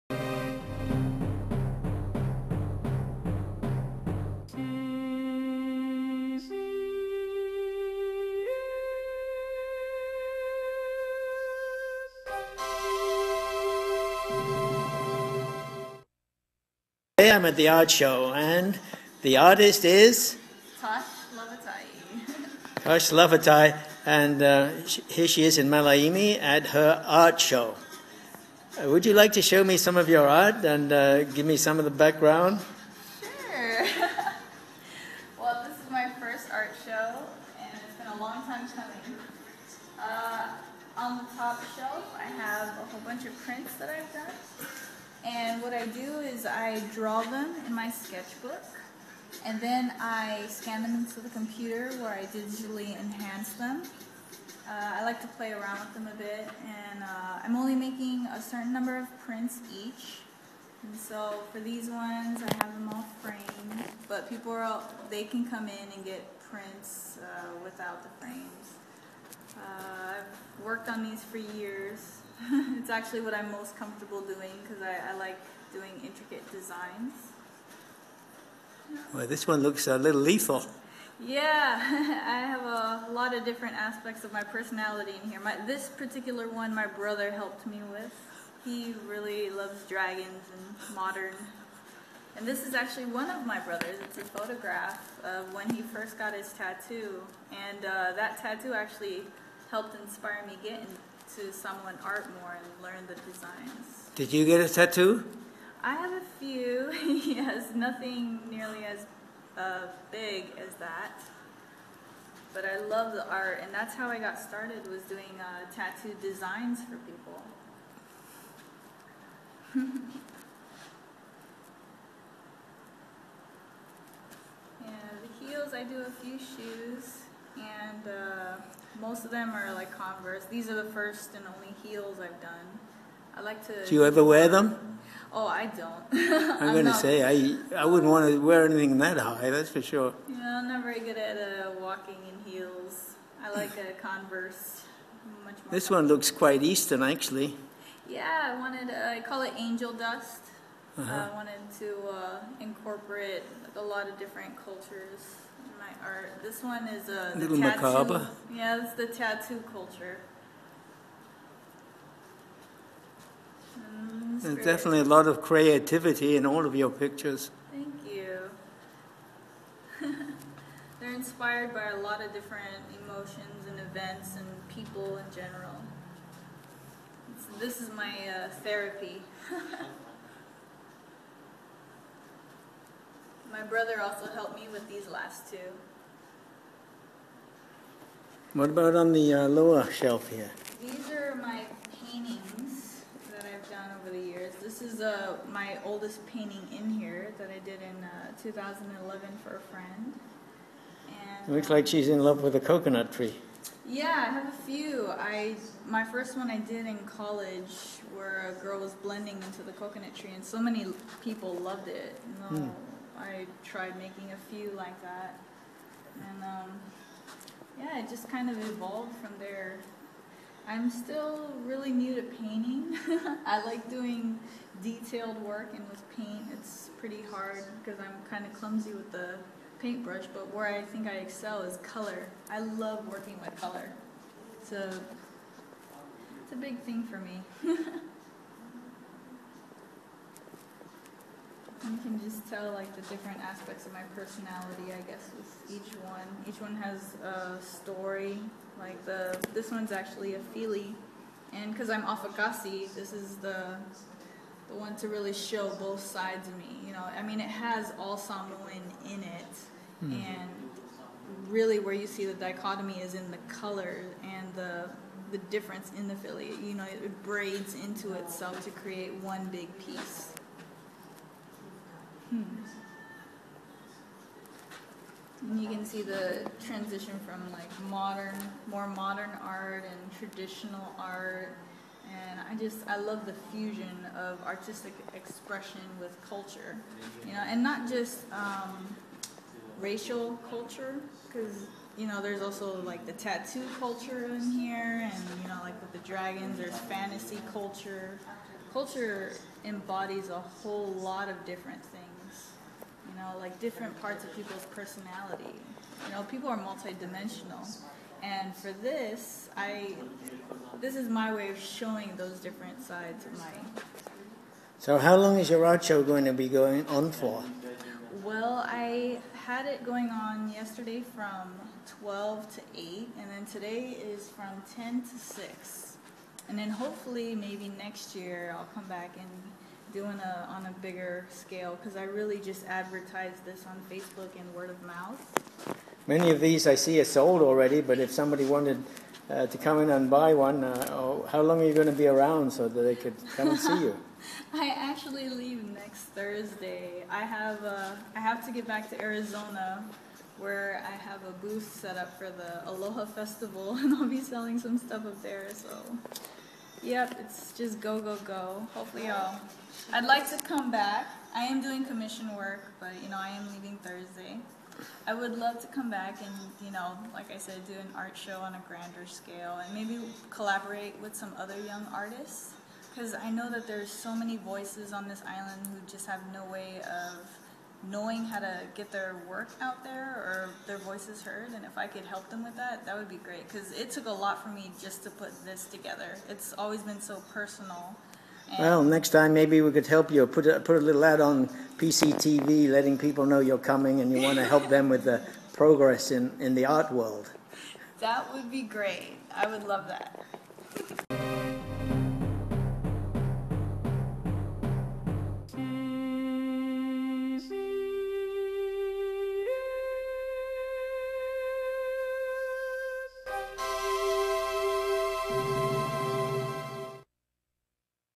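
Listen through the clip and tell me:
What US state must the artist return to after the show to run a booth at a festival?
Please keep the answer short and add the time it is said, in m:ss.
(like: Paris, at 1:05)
Arizona, at 5:49.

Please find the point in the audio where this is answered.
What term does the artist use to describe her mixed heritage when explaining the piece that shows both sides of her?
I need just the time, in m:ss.
4:12.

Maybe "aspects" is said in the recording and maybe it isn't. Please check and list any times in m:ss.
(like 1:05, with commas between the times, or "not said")
1:23, 4:03.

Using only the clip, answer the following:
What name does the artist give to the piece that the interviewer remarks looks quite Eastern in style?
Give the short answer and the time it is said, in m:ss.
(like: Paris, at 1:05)
Angel Dust, at 2:29.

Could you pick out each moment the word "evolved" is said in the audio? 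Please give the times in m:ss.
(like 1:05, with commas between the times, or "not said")
3:38.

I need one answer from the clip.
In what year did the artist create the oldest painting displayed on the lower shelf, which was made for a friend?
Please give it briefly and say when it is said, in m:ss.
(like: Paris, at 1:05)
2011, at 3:18.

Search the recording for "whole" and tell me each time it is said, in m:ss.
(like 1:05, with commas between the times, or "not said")
0:42, 5:00.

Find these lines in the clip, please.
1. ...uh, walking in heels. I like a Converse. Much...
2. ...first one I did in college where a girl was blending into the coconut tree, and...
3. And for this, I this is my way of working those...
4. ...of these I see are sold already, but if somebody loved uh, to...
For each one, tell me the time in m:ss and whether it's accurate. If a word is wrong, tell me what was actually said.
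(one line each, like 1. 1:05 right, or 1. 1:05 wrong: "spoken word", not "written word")
1. 2:21 right
2. 3:26 right
3. 5:08 wrong: "showing", not "working"
4. 5:36 wrong: "wanted", not "loved".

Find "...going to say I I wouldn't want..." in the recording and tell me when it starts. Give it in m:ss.
2:16.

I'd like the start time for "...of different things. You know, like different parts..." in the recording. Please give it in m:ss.
5:01.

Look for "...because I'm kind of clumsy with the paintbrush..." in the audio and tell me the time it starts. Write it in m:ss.
3:47.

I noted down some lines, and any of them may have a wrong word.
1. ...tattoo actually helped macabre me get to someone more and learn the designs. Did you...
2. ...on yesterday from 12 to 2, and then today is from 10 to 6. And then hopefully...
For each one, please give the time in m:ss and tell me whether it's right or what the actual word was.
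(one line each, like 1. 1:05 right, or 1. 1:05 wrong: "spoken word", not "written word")
1. 1:38 wrong: "inspire", not "macabre"
2. 5:20 wrong: "8", not "2".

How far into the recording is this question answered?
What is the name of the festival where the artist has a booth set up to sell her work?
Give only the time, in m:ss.
5:52.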